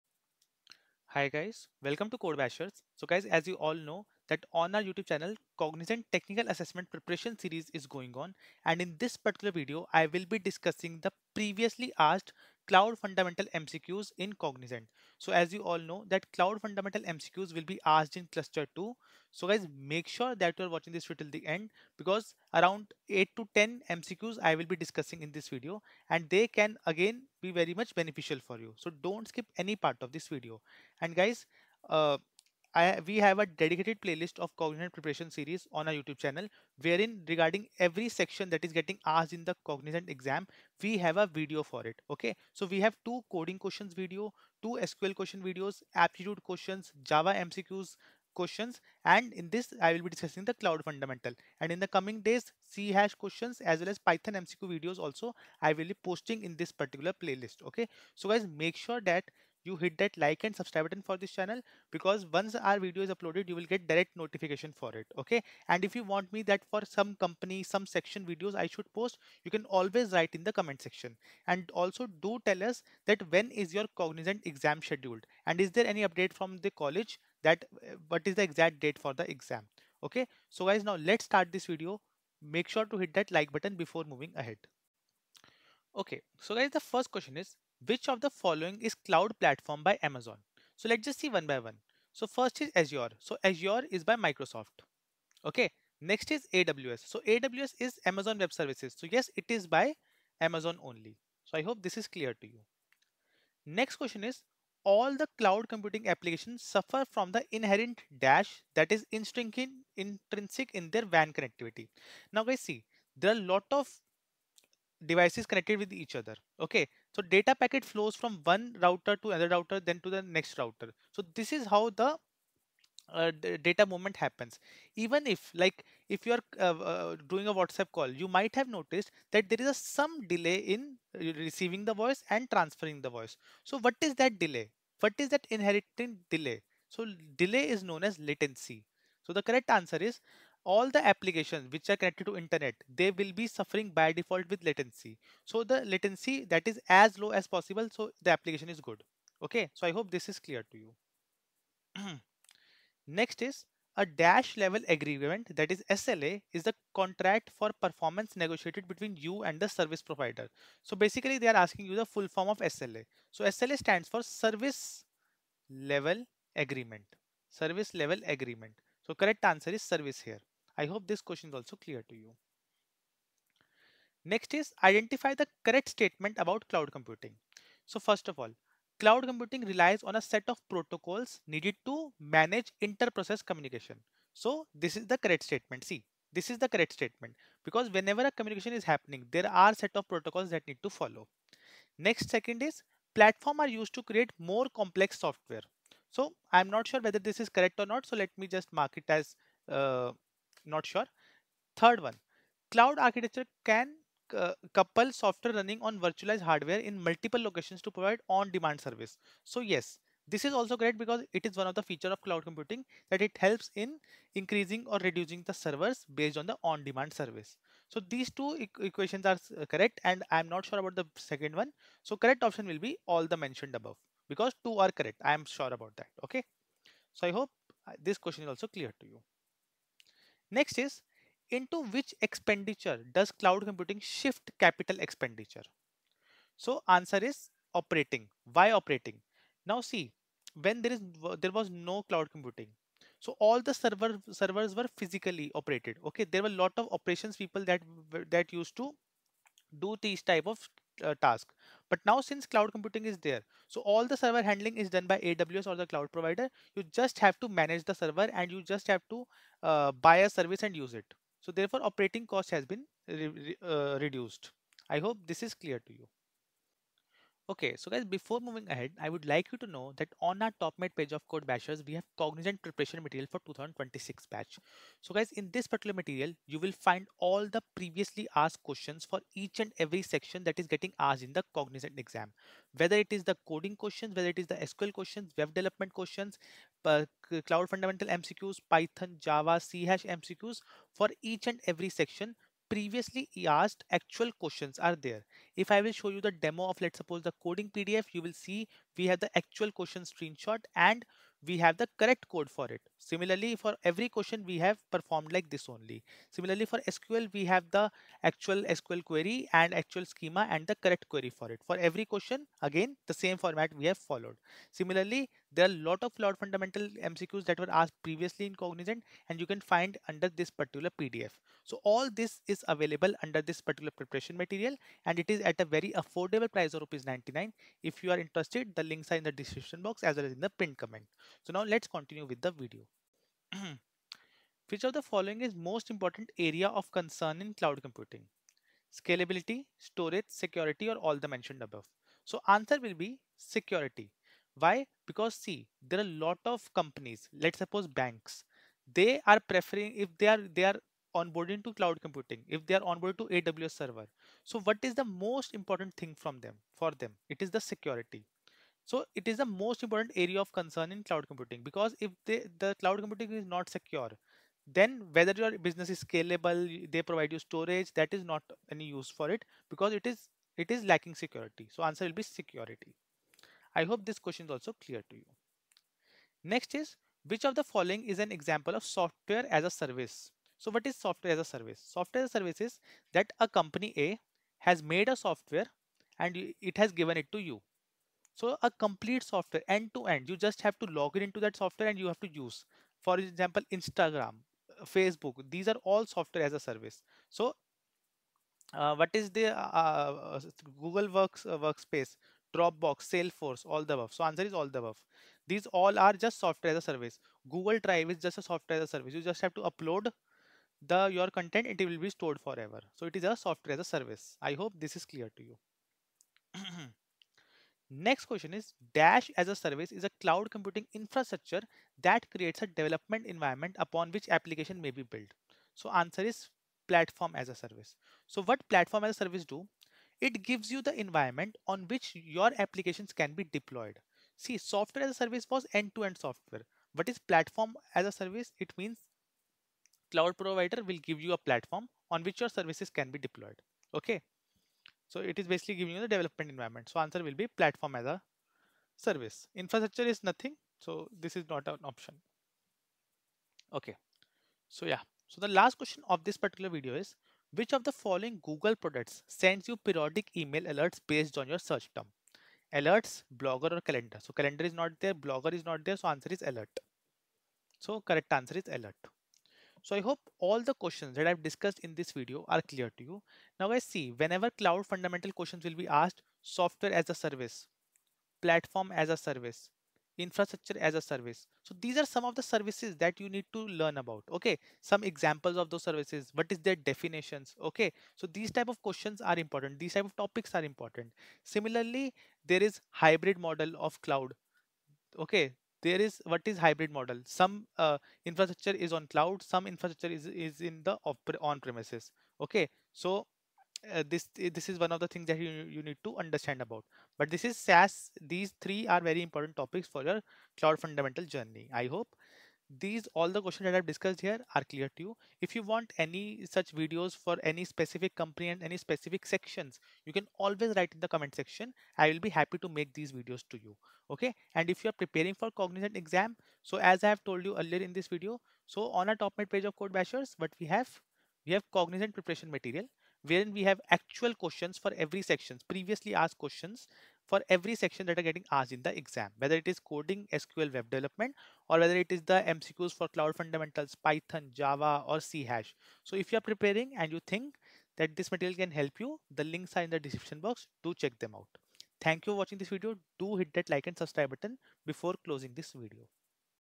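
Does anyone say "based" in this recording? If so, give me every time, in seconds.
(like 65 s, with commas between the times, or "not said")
216 s, 461 s.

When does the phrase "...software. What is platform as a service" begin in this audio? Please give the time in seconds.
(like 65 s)
436 s.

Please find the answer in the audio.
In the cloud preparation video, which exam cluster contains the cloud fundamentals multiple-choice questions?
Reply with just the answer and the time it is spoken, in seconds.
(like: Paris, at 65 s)
Cluster 2, at 18 s.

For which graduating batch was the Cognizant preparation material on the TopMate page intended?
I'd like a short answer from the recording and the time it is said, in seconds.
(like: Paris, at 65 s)
2026, at 273 s.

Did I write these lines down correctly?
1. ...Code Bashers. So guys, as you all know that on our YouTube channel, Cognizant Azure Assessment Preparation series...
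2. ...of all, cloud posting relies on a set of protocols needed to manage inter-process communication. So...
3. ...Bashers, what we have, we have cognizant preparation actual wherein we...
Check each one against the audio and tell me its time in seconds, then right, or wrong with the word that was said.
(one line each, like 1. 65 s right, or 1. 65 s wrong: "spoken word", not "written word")
1. 2 s wrong: "Technical", not "Azure"
2. 178 s wrong: "computing", not "posting"
3. 529 s wrong: "material", not "actual".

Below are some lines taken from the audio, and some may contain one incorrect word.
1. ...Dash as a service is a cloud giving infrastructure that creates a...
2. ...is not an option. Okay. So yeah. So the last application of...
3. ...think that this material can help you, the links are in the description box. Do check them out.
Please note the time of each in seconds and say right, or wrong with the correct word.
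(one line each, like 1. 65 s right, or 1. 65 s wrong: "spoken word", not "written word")
1. 418 s wrong: "computing", not "giving"
2. 451 s wrong: "question", not "application"
3. 547 s right.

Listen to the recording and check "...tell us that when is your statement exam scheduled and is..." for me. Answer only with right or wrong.
wrong.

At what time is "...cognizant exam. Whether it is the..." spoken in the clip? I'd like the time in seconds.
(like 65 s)
281 s.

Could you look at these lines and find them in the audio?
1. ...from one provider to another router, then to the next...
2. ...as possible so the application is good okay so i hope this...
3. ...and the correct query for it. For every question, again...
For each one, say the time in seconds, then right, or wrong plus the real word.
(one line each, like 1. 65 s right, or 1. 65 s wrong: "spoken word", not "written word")
1. 118 s wrong: "router", not "provider"
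2. 147 s right
3. 310 s right.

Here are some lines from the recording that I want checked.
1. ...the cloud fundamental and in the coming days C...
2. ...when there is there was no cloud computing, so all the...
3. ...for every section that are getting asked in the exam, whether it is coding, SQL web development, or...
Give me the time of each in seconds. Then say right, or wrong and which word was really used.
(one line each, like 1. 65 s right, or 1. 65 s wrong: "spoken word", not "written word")
1. 50 s right
2. 240 s right
3. 537 s right.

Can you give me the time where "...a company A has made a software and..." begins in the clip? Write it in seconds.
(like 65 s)
383 s.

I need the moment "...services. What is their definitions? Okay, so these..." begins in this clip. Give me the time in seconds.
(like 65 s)
485 s.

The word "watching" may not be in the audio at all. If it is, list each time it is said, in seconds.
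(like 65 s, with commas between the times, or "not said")
20 s, 552 s.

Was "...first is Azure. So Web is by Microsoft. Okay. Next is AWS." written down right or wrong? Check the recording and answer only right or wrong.
wrong.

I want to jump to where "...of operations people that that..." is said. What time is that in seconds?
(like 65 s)
246 s.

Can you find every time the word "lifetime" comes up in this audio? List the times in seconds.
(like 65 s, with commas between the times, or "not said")
not said.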